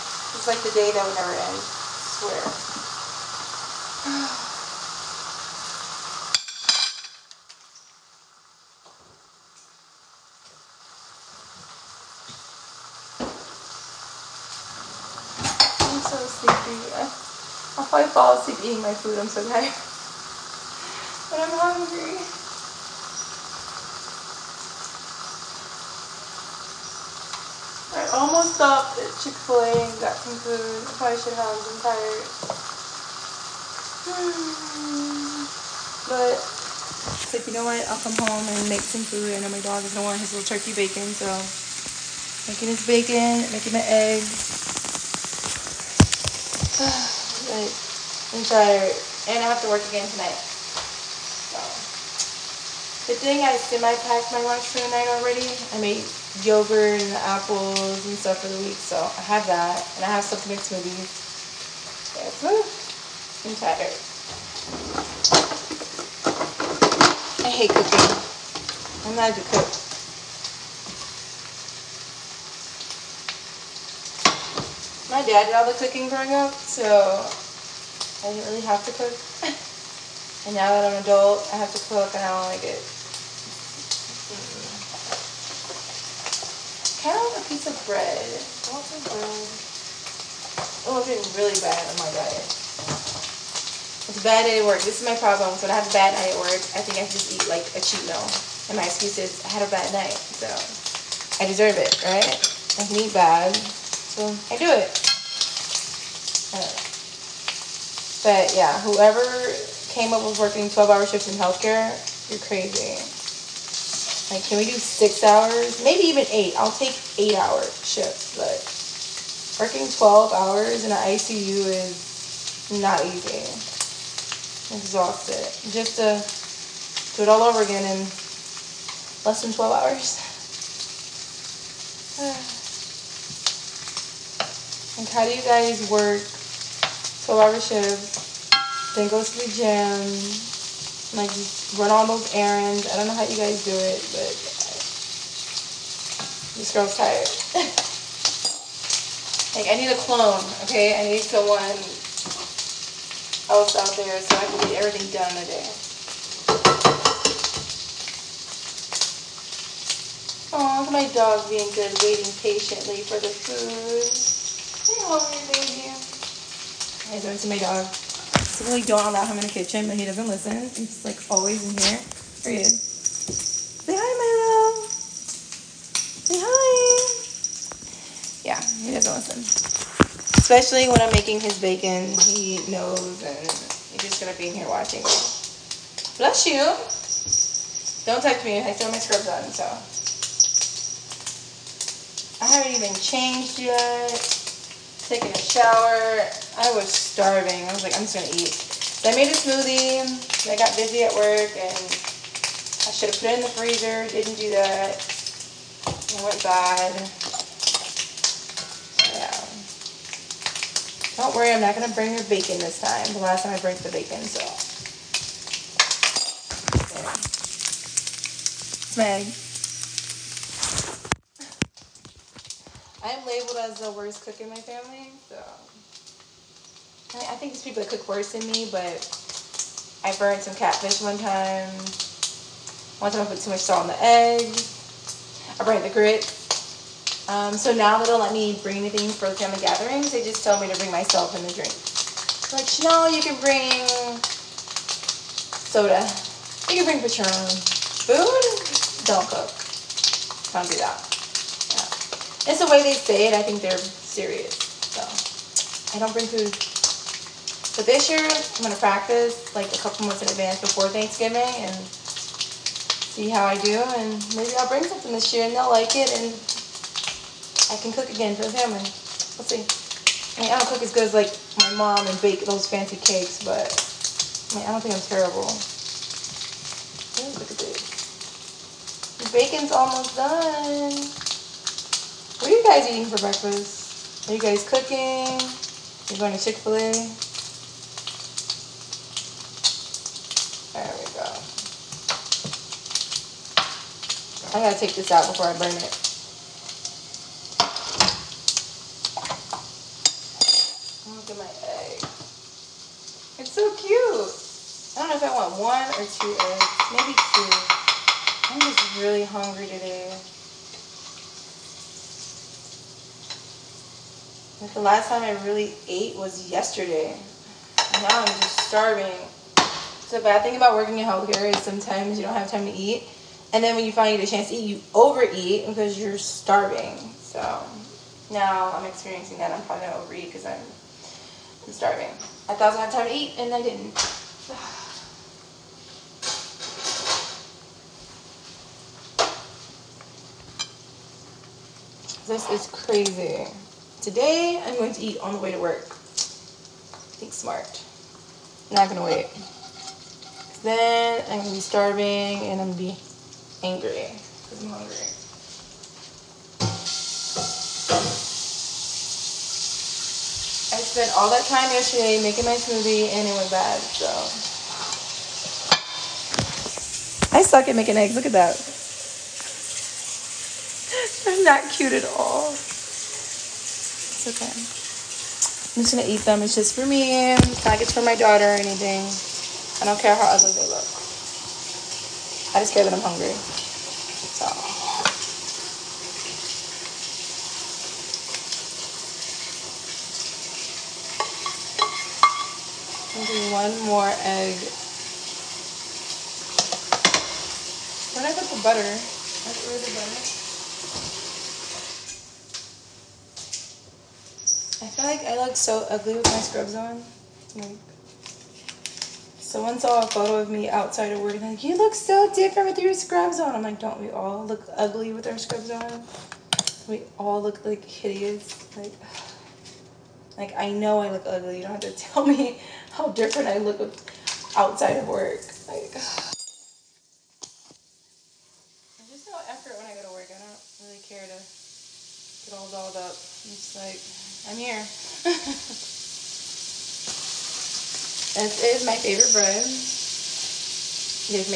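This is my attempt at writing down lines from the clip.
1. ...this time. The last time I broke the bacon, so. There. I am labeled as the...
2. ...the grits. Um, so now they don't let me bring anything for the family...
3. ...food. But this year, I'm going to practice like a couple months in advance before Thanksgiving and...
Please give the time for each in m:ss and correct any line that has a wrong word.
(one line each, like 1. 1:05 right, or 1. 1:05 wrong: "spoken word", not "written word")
1. 3:32 right
2. 3:55 right
3. 4:16 right.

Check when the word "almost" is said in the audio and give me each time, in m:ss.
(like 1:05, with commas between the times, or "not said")
0:28, 4:39.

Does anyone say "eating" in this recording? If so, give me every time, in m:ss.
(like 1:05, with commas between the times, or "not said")
0:18, 4:42.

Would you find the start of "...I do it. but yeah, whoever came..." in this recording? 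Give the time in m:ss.
1:44.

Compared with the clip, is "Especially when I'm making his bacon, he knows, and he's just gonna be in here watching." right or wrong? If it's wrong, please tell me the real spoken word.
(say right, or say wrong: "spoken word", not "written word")
right.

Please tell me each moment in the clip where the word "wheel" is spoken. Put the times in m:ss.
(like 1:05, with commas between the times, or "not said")
not said.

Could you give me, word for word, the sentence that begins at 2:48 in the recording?
We don't allow him in the kitchen, but he doesn't listen.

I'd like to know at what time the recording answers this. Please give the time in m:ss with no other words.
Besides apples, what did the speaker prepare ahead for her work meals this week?
0:56.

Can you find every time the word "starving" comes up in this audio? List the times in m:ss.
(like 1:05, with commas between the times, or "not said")
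3:17, 5:18, 5:26, 5:31, 5:51.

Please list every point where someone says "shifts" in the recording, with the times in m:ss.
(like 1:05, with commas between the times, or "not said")
1:51, 1:57, 2:17.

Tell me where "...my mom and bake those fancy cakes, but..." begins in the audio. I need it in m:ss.
4:31.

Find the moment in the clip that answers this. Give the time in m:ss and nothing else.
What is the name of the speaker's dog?
2:54.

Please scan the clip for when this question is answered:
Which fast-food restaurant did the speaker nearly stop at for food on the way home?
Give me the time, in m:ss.
0:29.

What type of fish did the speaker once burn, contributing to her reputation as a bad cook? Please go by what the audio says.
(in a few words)
Catfish.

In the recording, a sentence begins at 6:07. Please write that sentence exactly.
I suck at making eggs, look at that.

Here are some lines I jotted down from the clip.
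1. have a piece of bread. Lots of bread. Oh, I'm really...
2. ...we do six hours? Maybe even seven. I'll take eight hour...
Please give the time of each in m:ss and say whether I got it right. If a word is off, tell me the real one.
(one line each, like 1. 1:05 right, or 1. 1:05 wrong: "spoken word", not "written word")
1. 1:27 right
2. 1:54 wrong: "eight", not "seven".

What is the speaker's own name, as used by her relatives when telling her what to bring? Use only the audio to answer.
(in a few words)
Chanel.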